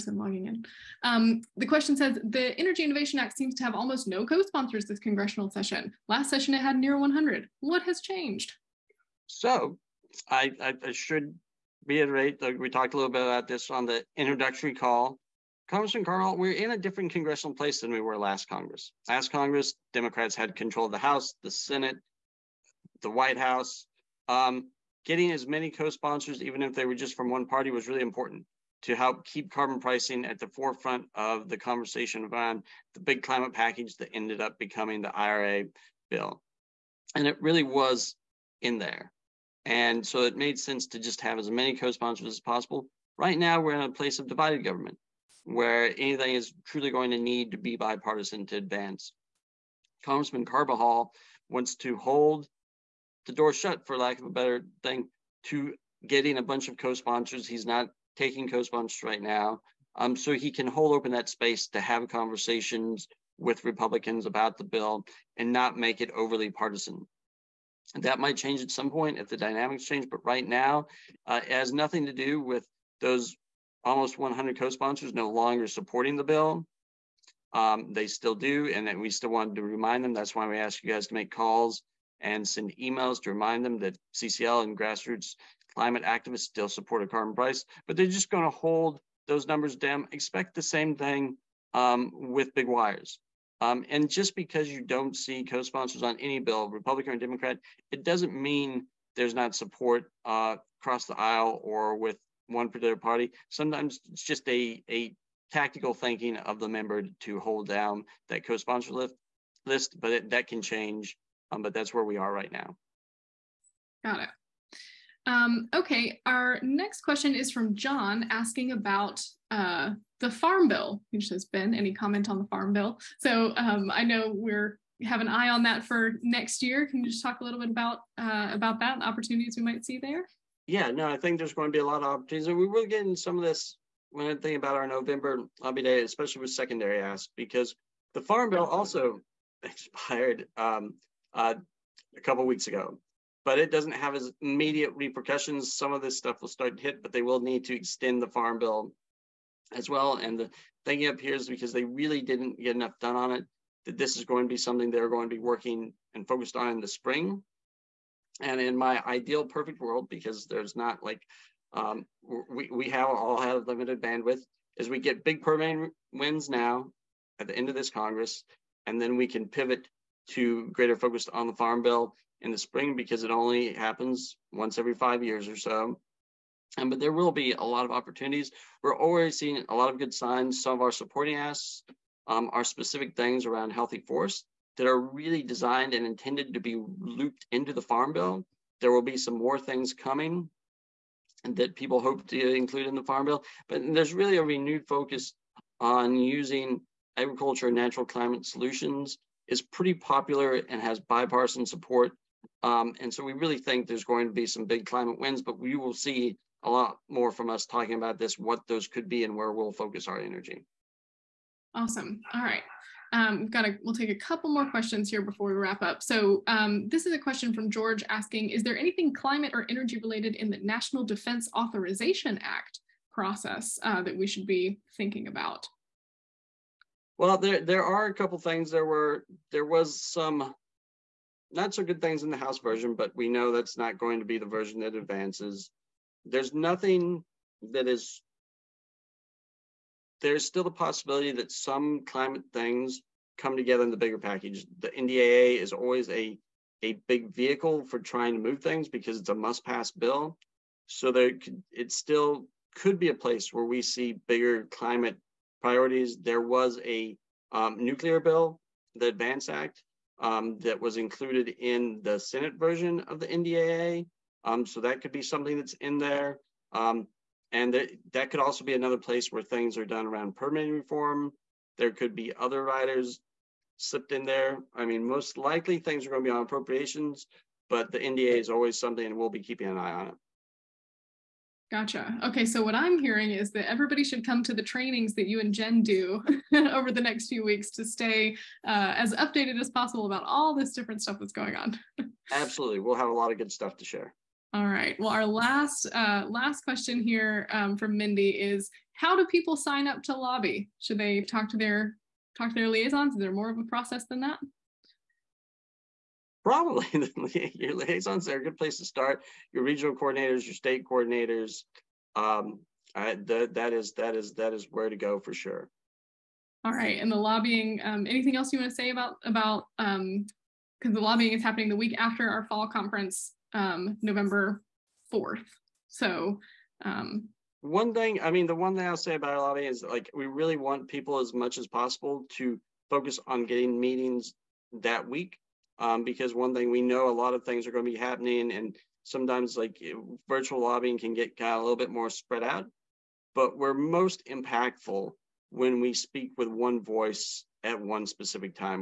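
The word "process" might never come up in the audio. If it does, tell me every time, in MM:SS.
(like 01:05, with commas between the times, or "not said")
03:43, 05:03.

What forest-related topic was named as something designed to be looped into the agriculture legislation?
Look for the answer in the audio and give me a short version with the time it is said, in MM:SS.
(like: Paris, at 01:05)
healthy forest, at 03:03.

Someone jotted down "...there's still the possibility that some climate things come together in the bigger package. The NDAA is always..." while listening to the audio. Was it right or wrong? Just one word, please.
right.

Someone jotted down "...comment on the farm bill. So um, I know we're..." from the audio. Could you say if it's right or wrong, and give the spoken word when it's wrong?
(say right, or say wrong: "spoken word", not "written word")
right.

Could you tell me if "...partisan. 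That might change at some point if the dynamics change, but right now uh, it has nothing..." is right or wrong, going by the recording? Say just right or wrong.
right.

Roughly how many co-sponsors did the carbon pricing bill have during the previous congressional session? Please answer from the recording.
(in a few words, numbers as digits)
100.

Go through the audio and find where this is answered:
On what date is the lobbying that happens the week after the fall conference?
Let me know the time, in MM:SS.
05:24.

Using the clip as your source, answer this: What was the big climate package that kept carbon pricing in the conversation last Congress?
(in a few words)
IRA.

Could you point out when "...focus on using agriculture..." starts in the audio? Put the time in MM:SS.
03:14.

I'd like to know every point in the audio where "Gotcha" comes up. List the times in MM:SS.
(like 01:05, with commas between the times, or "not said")
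04:41.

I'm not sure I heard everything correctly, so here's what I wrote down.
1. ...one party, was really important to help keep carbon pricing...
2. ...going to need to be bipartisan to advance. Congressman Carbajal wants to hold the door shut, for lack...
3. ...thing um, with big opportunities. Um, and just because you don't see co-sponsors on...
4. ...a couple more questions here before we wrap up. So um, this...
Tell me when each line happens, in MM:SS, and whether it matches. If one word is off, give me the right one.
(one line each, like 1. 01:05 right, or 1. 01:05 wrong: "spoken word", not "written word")
1. 00:27 right
2. 00:46 right
3. 01:30 wrong: "wires", not "opportunities"
4. 03:34 right.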